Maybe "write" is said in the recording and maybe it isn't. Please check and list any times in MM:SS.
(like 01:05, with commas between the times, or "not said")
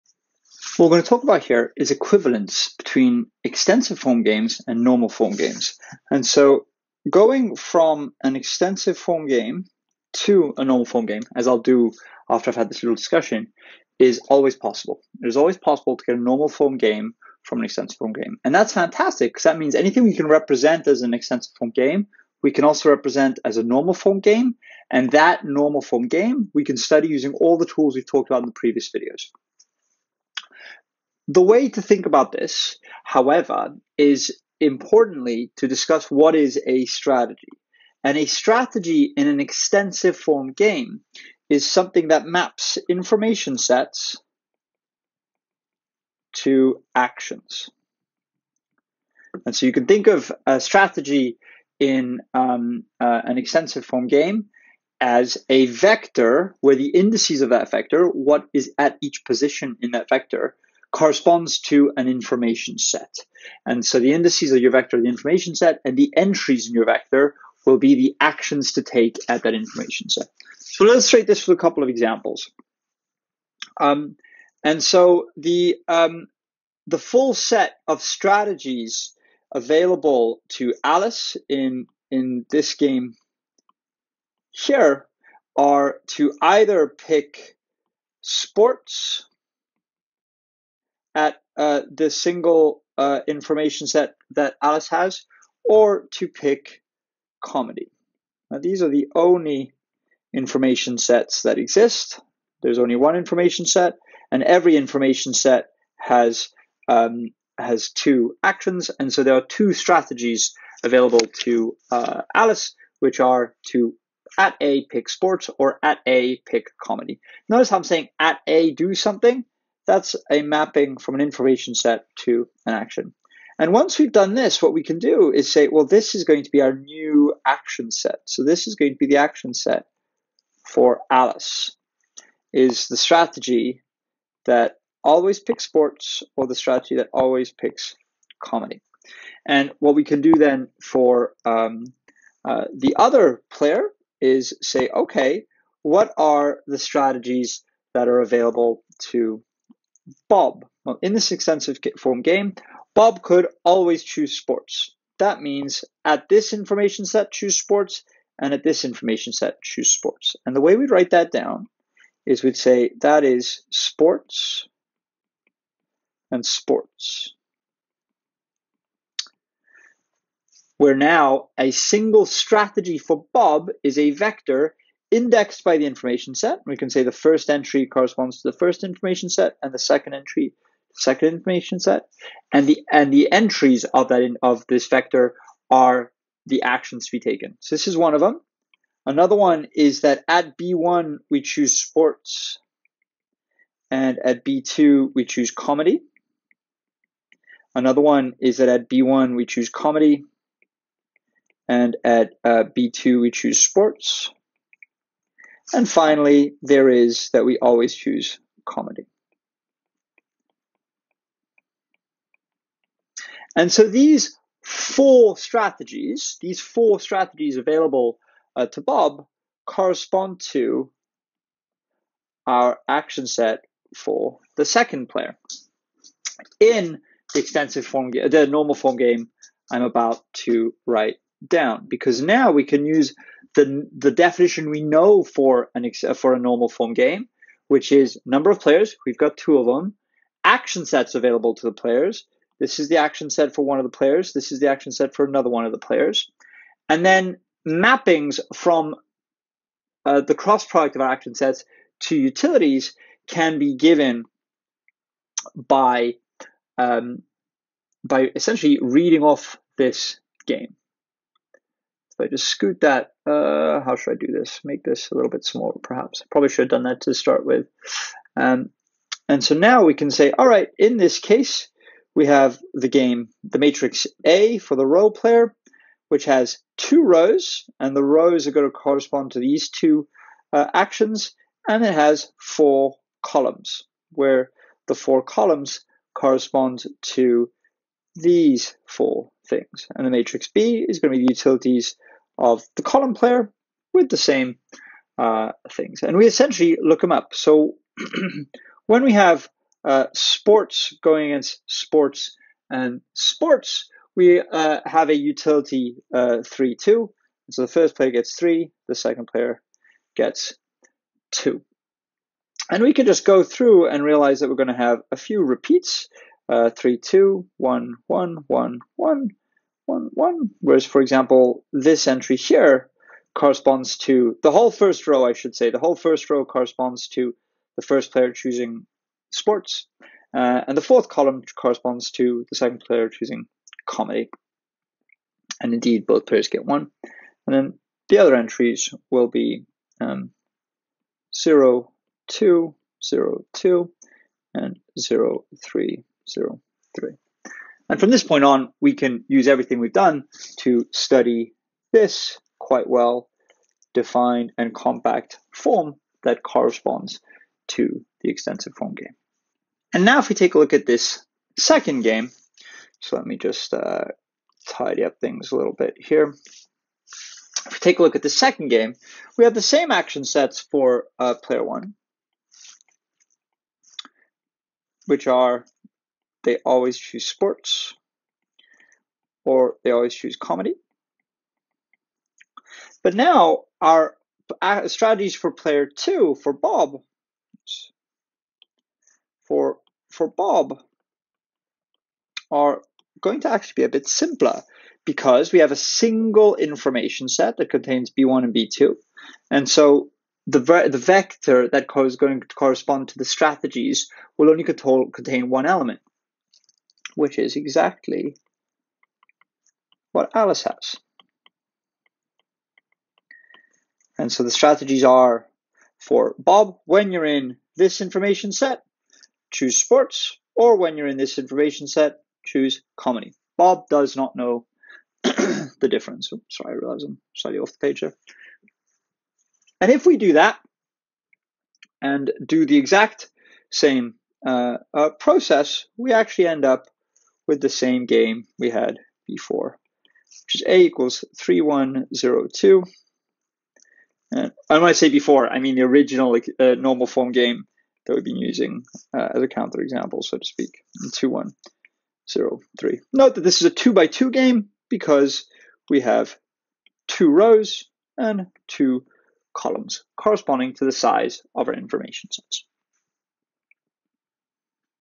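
02:40, 03:50.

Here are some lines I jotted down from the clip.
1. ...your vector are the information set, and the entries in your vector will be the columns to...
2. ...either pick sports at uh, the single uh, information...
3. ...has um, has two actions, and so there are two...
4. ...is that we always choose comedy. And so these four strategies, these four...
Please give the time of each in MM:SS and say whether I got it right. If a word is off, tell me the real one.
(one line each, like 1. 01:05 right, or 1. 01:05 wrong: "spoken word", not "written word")
1. 01:04 wrong: "actions", not "columns"
2. 01:26 right
3. 01:45 right
4. 03:26 right.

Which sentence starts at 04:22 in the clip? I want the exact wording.
I just scoot that, uh, how should I do this?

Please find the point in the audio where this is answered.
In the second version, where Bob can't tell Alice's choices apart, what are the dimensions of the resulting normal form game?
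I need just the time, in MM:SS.
07:33.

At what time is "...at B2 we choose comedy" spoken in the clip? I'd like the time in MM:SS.
03:14.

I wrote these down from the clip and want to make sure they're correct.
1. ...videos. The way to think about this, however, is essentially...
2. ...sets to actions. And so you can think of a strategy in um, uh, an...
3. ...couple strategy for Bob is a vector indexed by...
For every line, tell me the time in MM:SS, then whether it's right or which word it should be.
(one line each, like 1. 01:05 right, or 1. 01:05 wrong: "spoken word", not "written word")
1. 00:28 wrong: "importantly", not "essentially"
2. 00:43 right
3. 02:51 wrong: "single", not "couple".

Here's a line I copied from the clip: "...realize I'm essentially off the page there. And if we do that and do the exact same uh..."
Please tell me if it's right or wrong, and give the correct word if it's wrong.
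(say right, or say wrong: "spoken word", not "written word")
wrong: "slightly", not "essentially".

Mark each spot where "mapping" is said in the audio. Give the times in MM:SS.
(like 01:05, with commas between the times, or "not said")
02:00, 04:07.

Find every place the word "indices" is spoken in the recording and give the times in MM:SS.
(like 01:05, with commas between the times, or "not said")
00:56, 01:04.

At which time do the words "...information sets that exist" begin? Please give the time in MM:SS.
01:40.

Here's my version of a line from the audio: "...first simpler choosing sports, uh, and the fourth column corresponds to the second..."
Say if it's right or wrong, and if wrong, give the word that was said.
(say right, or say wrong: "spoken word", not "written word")
wrong: "player", not "simpler".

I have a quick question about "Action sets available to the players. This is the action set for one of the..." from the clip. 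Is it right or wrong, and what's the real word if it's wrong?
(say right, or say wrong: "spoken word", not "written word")
right.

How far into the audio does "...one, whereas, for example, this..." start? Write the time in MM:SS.
05:20.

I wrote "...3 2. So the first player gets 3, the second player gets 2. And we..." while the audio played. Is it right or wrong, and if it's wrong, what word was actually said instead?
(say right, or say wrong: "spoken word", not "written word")
right.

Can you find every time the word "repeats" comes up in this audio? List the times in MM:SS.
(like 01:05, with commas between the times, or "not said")
05:15.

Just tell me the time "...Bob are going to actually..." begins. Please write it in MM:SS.
06:30.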